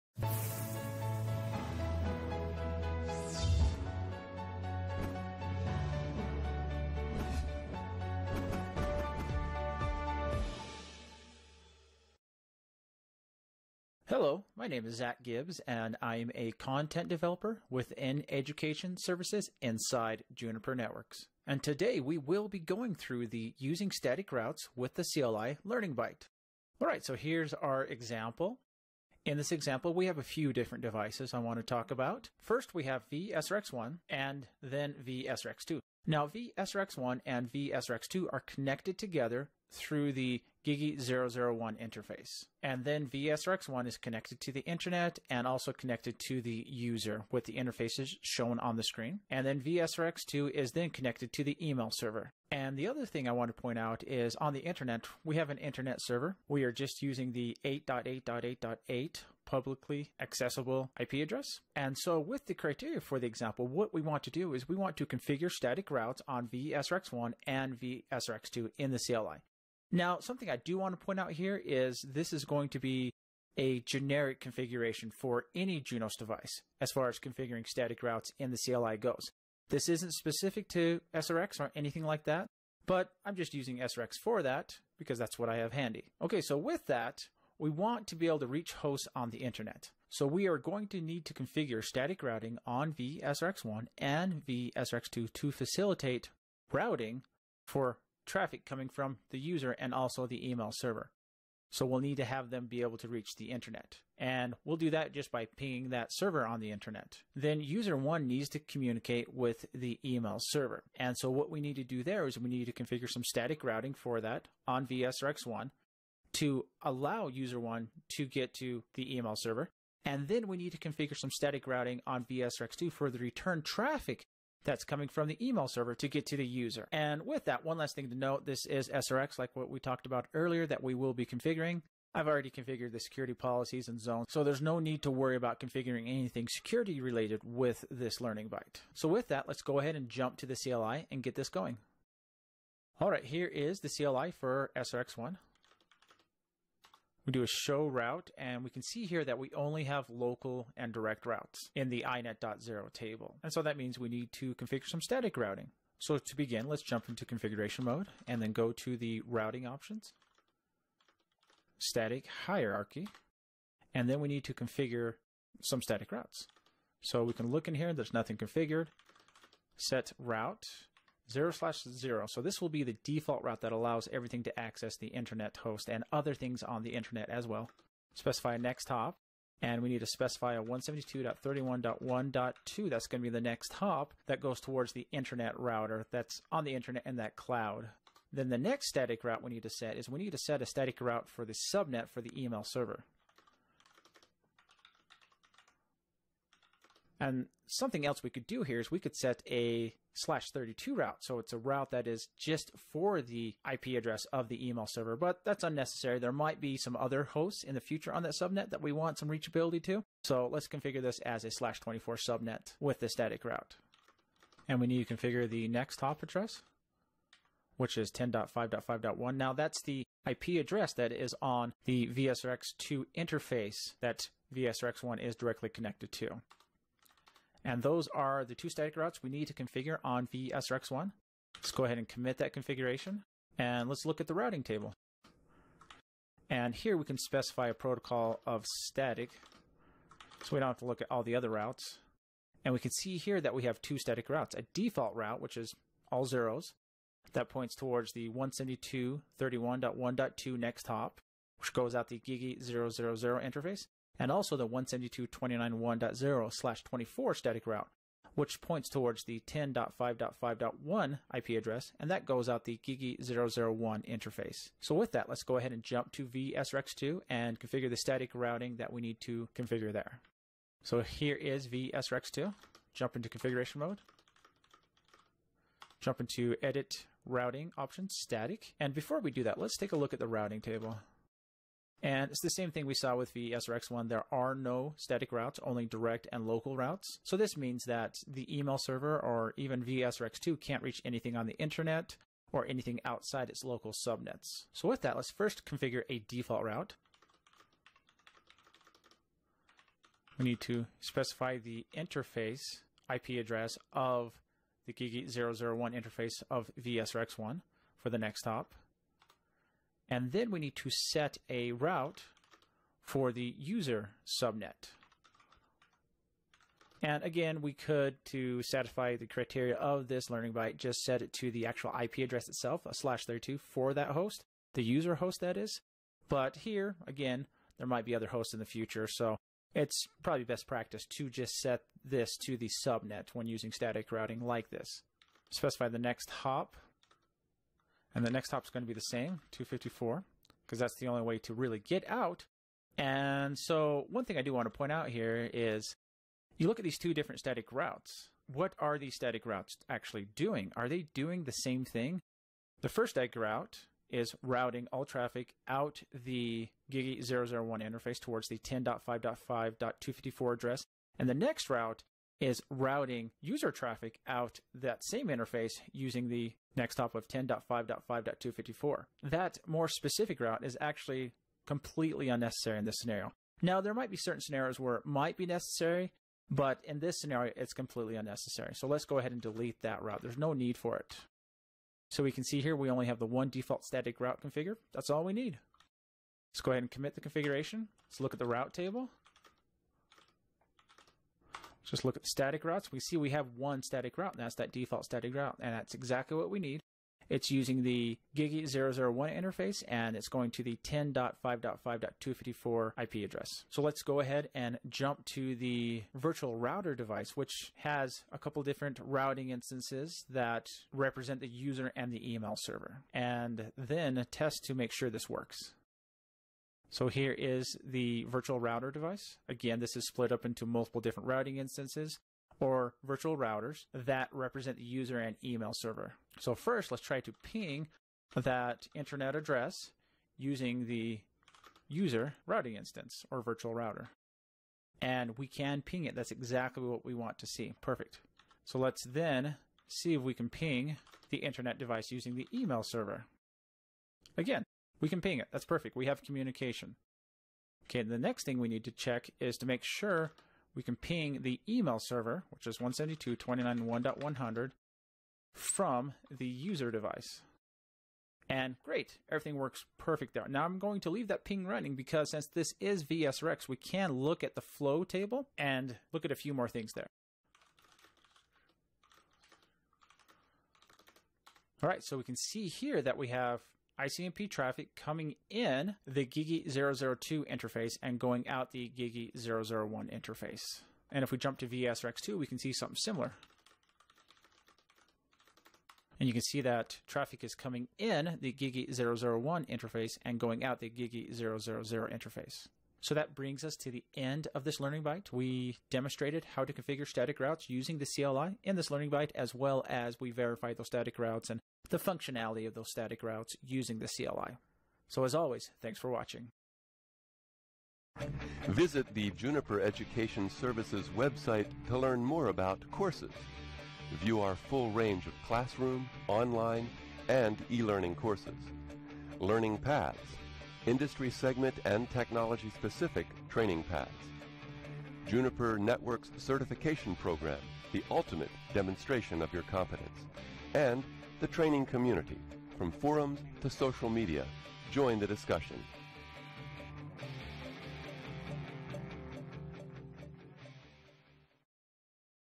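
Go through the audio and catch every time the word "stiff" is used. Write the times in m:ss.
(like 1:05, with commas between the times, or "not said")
not said.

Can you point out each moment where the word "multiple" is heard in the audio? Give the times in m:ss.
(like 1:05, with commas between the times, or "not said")
7:00.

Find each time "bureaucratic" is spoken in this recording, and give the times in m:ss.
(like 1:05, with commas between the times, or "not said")
not said.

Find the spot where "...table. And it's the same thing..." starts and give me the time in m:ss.
4:40.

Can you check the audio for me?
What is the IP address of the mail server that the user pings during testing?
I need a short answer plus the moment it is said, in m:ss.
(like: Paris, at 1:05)
172.29.1.100, at 7:32.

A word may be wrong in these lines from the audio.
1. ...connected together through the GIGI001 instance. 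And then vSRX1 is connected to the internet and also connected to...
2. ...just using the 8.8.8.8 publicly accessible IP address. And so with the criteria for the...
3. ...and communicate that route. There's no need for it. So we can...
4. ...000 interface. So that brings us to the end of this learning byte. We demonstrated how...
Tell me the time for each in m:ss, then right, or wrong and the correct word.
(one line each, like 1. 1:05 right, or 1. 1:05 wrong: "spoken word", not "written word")
1. 0:38 wrong: "interface", not "instance"
2. 0:56 right
3. 6:19 wrong: "delete", not "communicate"
4. 8:11 right.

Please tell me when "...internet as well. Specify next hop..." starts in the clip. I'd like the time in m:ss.
2:56.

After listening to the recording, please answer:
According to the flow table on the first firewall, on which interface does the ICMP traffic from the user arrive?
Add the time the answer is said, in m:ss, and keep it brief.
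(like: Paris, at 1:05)
GigE 0/0/2, at 7:56.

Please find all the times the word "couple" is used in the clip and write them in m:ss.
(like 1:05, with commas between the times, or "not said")
6:48.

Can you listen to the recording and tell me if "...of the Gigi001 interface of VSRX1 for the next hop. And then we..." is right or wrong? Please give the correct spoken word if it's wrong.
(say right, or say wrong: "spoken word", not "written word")
right.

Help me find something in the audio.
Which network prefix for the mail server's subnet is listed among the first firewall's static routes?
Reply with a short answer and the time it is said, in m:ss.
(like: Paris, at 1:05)
172.29.1.0/24, at 4:14.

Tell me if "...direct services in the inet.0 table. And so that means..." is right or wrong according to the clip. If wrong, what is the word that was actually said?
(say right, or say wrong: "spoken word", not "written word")
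wrong: "routes", not "services".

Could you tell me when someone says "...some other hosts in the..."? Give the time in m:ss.
3:26.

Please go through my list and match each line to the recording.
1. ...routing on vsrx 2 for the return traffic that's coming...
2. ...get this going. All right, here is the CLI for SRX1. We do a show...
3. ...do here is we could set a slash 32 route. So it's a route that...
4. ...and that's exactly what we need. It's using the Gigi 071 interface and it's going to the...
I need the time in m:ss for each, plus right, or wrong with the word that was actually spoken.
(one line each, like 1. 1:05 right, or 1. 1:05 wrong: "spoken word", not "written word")
1. 2:01 right
2. 2:21 right
3. 3:18 right
4. 6:35 wrong: "001", not "071".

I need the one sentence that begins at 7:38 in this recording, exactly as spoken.
And great, everything works perfect there.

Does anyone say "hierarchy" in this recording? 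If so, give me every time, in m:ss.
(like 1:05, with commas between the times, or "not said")
2:42.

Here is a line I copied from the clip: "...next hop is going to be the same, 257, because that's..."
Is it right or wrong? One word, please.
wrong.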